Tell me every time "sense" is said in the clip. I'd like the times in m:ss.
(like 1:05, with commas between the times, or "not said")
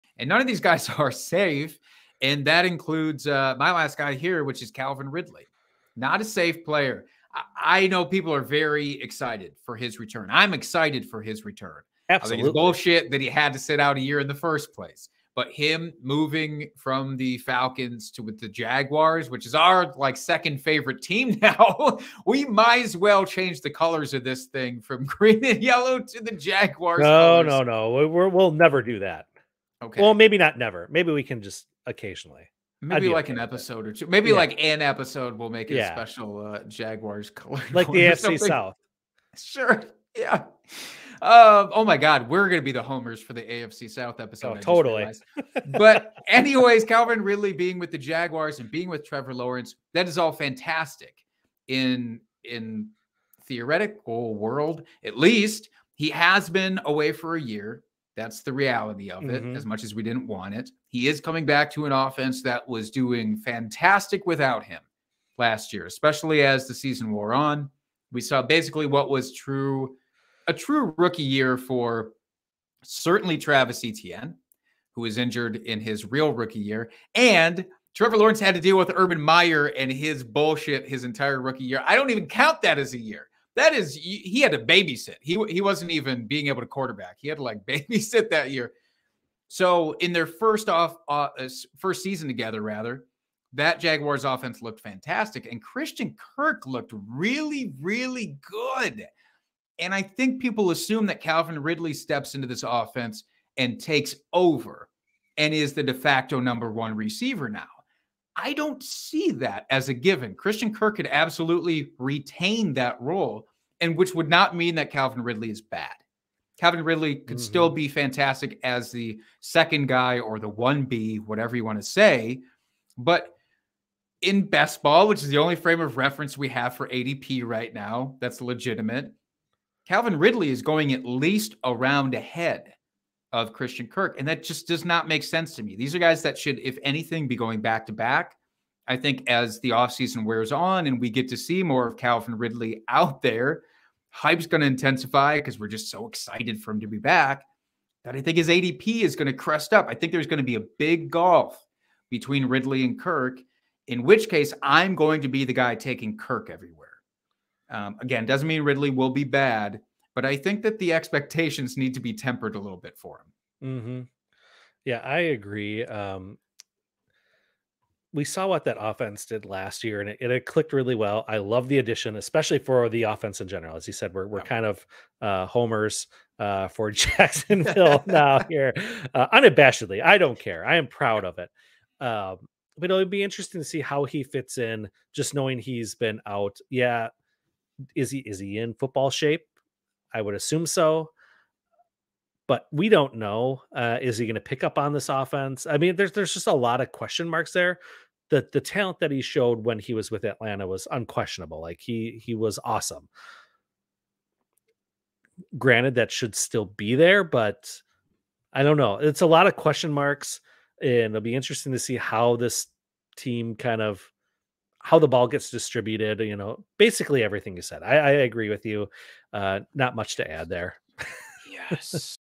2:15.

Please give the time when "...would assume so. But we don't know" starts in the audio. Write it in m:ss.
3:10.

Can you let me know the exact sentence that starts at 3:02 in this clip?
Um, but it'll be interesting to see how he fits in.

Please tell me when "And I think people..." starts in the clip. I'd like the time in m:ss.
1:39.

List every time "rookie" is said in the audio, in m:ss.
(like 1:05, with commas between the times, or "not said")
1:10, 1:16, 1:21.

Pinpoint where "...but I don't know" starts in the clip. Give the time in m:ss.
3:27.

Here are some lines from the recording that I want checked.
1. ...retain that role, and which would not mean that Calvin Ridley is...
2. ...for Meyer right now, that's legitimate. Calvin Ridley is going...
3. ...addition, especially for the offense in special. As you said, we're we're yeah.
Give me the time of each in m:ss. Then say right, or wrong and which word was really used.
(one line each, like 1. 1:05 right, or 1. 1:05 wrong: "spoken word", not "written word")
1. 1:51 right
2. 2:06 wrong: "ADP", not "Meyer"
3. 2:51 wrong: "general", not "special".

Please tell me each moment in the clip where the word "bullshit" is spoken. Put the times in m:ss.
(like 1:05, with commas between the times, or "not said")
0:12, 1:20.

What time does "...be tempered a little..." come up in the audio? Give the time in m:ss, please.
2:41.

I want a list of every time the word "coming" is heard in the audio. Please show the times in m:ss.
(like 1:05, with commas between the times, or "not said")
1:01.